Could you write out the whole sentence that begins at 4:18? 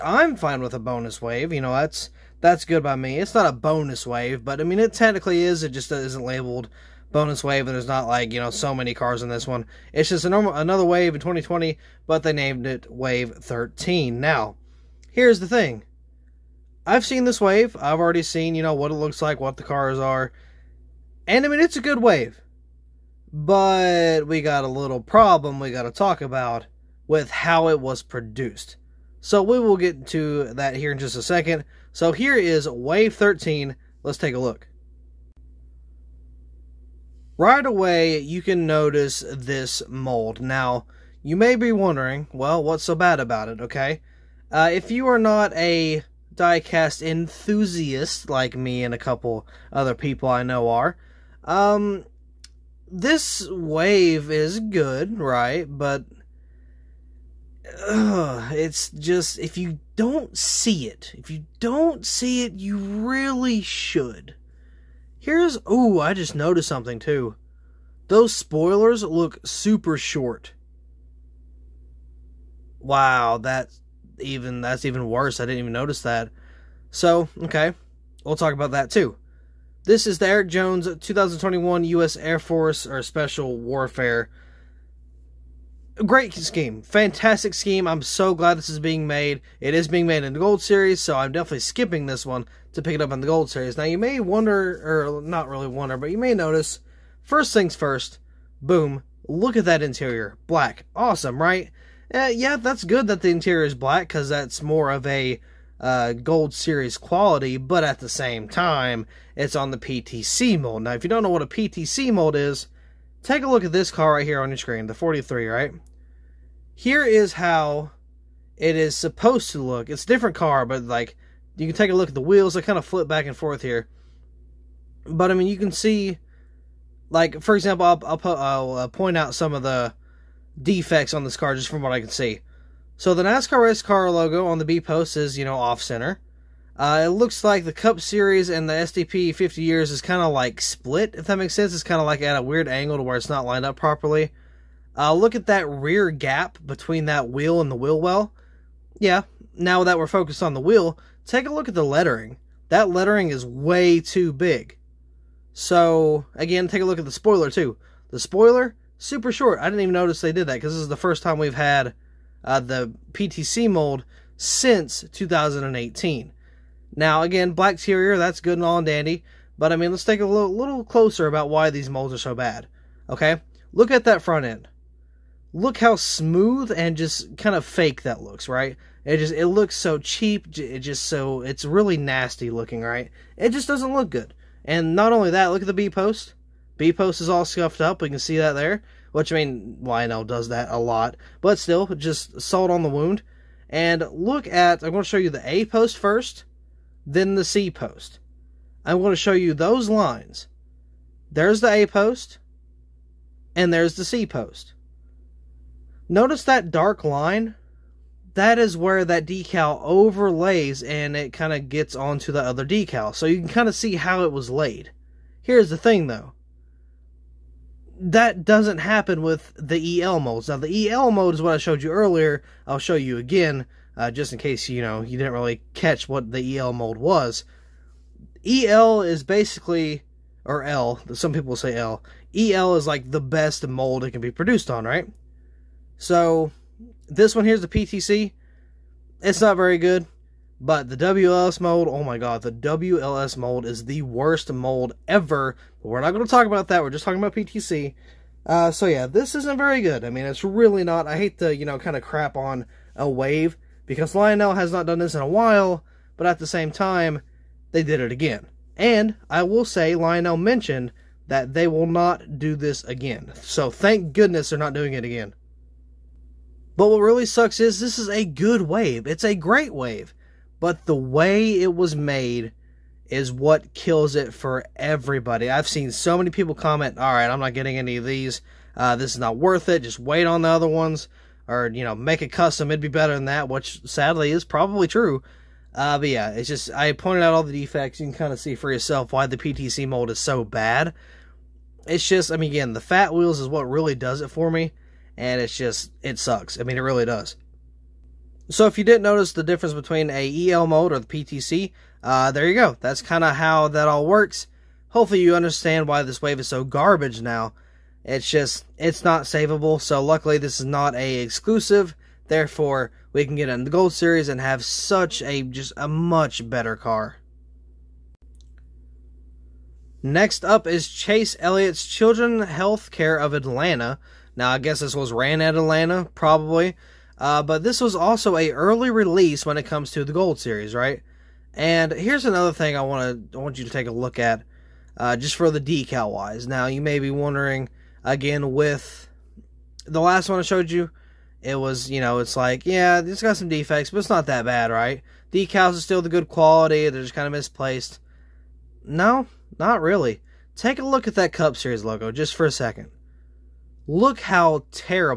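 And I will say, Lionel mentioned that they will not do this again.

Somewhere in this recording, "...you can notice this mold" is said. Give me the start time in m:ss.
0:38.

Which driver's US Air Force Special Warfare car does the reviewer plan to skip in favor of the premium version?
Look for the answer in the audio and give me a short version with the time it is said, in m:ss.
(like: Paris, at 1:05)
Erik Jones, at 1:20.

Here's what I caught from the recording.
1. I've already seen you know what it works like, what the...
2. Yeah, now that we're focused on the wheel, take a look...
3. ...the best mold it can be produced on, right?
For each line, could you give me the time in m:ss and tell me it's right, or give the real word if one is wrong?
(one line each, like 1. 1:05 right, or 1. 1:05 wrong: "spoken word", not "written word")
1. 0:17 wrong: "looks", not "works"
2. 2:28 right
3. 3:53 right.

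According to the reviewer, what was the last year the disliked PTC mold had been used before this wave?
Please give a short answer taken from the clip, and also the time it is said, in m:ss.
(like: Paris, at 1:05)
2018, at 2:45.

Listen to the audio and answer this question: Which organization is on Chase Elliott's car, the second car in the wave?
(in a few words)
Children Healthcare of Atlanta.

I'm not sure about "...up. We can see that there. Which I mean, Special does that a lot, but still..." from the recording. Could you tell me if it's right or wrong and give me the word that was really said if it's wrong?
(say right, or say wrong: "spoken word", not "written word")
wrong: "Lionel", not "Special".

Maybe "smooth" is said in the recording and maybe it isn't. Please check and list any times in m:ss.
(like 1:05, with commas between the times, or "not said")
2:55.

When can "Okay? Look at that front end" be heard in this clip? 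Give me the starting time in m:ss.
2:53.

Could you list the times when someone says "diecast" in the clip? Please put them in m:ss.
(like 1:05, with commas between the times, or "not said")
0:46.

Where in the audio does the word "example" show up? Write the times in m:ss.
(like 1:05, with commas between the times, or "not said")
2:07.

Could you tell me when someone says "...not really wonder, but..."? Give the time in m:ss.
1:35.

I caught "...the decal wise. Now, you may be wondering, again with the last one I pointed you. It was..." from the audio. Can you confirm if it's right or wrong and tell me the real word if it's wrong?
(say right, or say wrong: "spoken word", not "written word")
wrong: "showed", not "pointed".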